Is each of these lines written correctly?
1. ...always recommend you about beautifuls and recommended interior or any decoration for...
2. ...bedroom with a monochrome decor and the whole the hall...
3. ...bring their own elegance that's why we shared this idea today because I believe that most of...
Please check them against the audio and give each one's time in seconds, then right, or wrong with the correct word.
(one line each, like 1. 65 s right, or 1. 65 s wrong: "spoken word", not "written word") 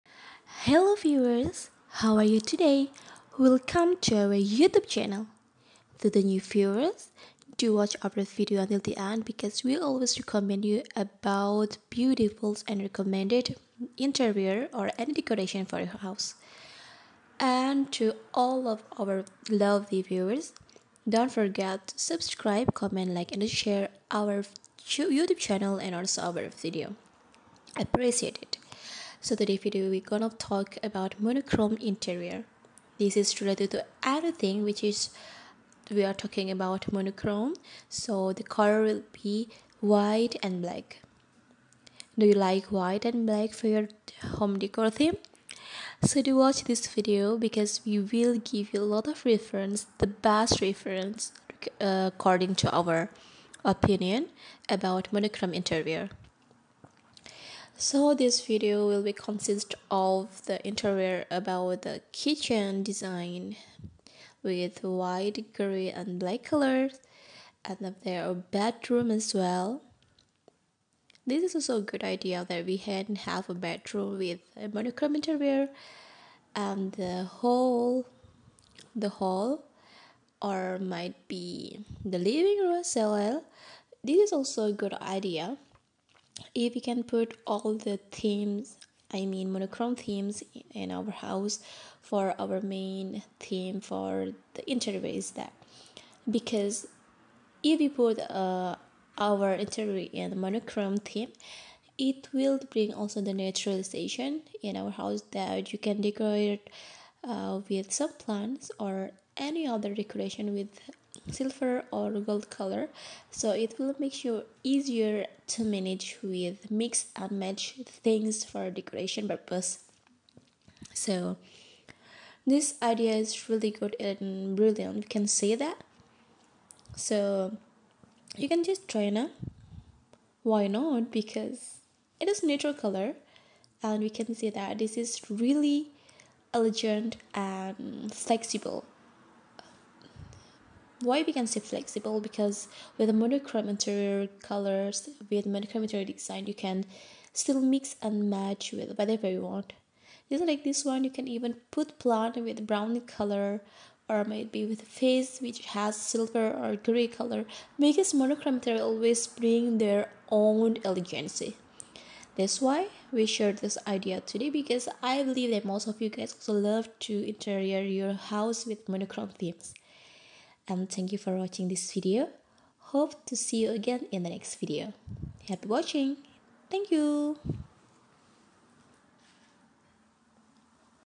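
1. 9 s right
2. 73 s wrong: "interior", not "decor"
3. 159 s right.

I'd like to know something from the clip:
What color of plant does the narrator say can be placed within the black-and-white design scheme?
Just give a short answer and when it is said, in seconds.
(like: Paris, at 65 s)
brown, at 152 s.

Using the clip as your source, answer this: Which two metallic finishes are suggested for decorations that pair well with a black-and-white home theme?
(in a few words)
silver or gold.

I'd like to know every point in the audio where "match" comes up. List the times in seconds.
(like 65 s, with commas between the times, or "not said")
117 s, 148 s.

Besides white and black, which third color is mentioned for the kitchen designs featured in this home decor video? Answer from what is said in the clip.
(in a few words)
grey.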